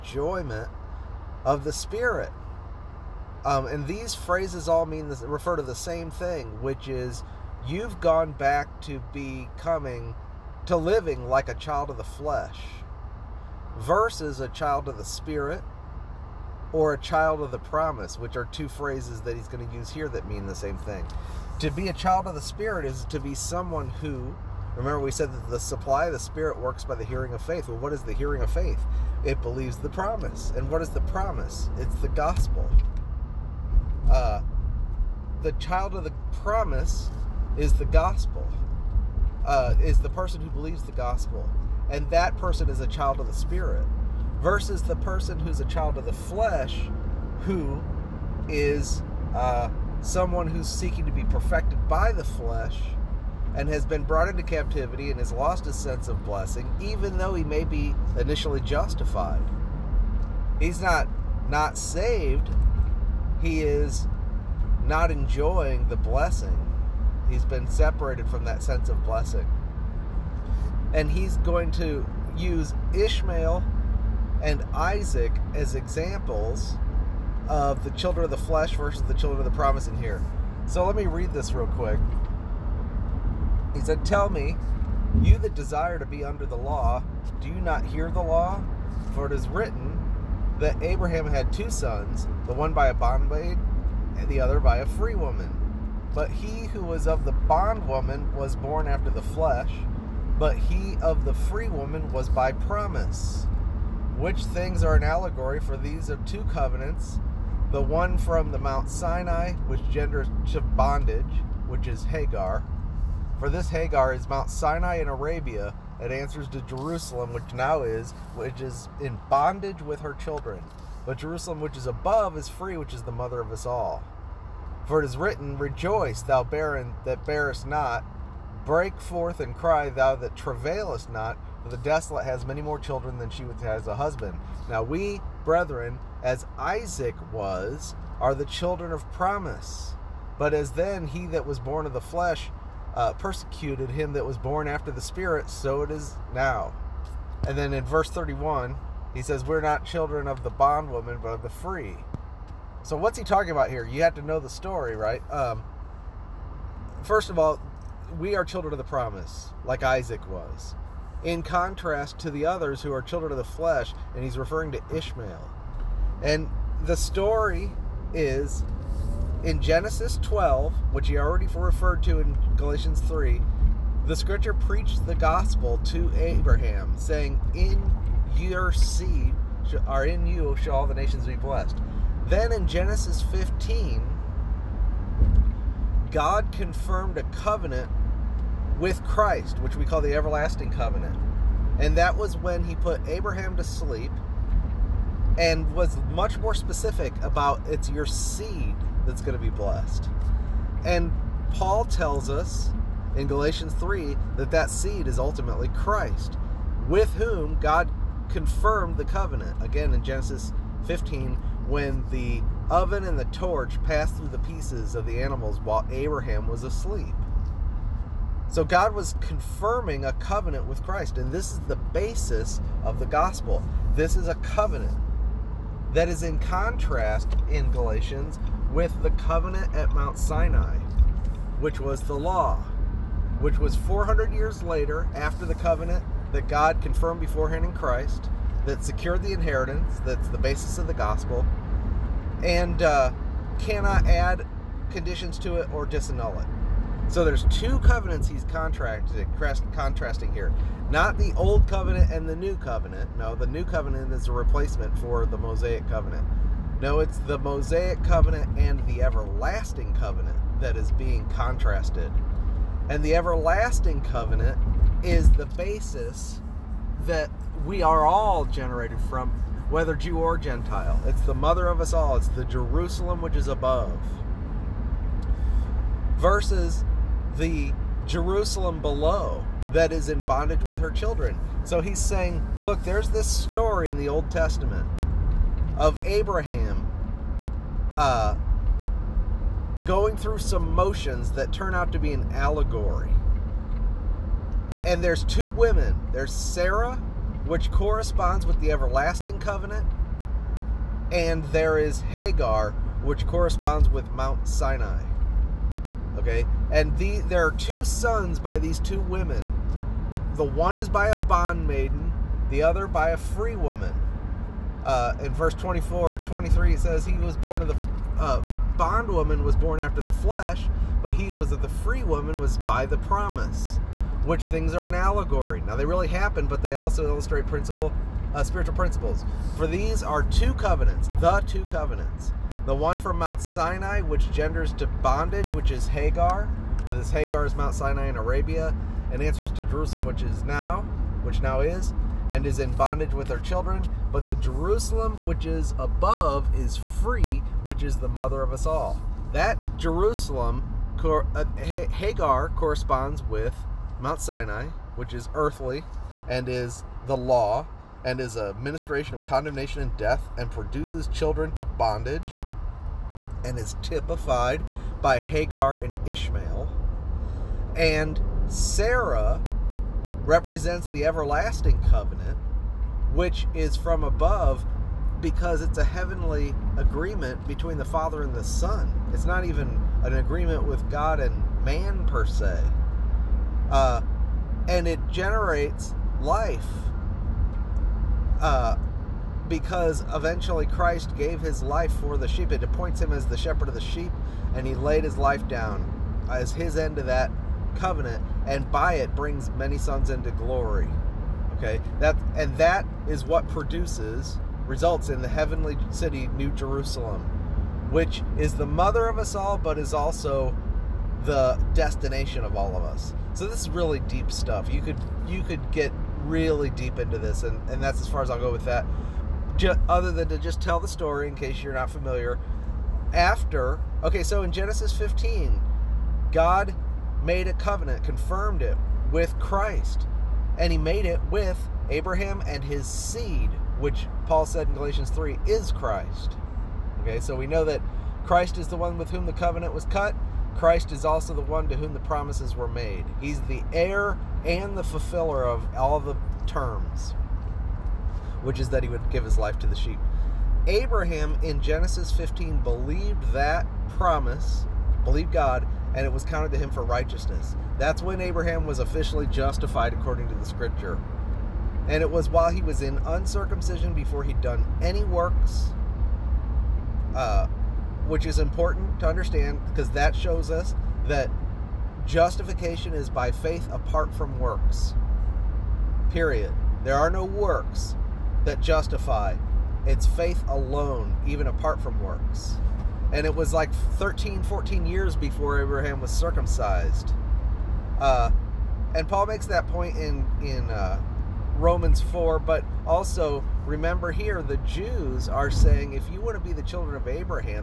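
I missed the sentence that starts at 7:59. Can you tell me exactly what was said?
It's faith alone, even apart from works.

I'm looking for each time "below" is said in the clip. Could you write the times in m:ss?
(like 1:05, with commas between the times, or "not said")
4:38.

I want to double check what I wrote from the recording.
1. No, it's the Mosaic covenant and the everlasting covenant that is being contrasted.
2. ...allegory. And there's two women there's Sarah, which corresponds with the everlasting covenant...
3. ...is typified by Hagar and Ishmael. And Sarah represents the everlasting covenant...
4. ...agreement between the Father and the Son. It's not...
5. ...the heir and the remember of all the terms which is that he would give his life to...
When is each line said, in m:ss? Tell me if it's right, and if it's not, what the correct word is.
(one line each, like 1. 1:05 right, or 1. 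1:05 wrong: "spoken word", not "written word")
1. 4:16 right
2. 4:52 right
3. 6:03 right
4. 6:16 right
5. 7:23 wrong: "fulfiller", not "remember".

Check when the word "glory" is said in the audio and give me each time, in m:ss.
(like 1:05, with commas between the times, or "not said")
6:40.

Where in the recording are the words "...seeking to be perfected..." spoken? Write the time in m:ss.
0:50.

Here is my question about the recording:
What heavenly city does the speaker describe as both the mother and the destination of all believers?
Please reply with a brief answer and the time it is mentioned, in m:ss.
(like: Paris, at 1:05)
New Jerusalem, at 6:46.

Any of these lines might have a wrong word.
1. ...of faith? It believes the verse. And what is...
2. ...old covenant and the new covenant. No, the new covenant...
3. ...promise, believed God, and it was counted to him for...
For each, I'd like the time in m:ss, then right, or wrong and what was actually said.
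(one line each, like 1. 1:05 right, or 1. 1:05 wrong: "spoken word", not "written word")
1. 0:28 wrong: "promise", not "verse"
2. 4:11 right
3. 7:33 right.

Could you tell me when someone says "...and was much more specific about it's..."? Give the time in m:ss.
3:15.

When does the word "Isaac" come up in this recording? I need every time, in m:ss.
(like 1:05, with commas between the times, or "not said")
1:14, 2:16, 2:39.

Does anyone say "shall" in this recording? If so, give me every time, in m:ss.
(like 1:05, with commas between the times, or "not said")
3:00.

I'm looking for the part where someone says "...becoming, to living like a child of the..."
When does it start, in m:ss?
0:09.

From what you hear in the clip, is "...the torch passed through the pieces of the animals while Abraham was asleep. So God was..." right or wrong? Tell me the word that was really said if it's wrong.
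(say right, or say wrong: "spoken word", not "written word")
right.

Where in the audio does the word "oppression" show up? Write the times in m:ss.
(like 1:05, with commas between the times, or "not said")
not said.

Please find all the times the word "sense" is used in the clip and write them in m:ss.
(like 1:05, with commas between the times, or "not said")
0:55, 1:08.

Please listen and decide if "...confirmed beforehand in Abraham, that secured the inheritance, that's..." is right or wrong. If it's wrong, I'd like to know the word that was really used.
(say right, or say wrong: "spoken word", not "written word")
wrong: "Christ", not "Abraham".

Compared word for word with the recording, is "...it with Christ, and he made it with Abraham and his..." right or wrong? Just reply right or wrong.
right.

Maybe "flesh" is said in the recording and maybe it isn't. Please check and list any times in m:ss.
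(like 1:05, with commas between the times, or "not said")
0:12, 0:46, 0:52, 1:18, 1:39, 2:22, 2:43, 5:20.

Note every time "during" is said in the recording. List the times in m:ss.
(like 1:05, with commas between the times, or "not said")
not said.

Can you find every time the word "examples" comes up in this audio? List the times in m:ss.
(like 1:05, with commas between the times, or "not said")
1:15.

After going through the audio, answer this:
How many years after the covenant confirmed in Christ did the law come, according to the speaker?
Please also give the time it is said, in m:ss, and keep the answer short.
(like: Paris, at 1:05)
400, at 3:53.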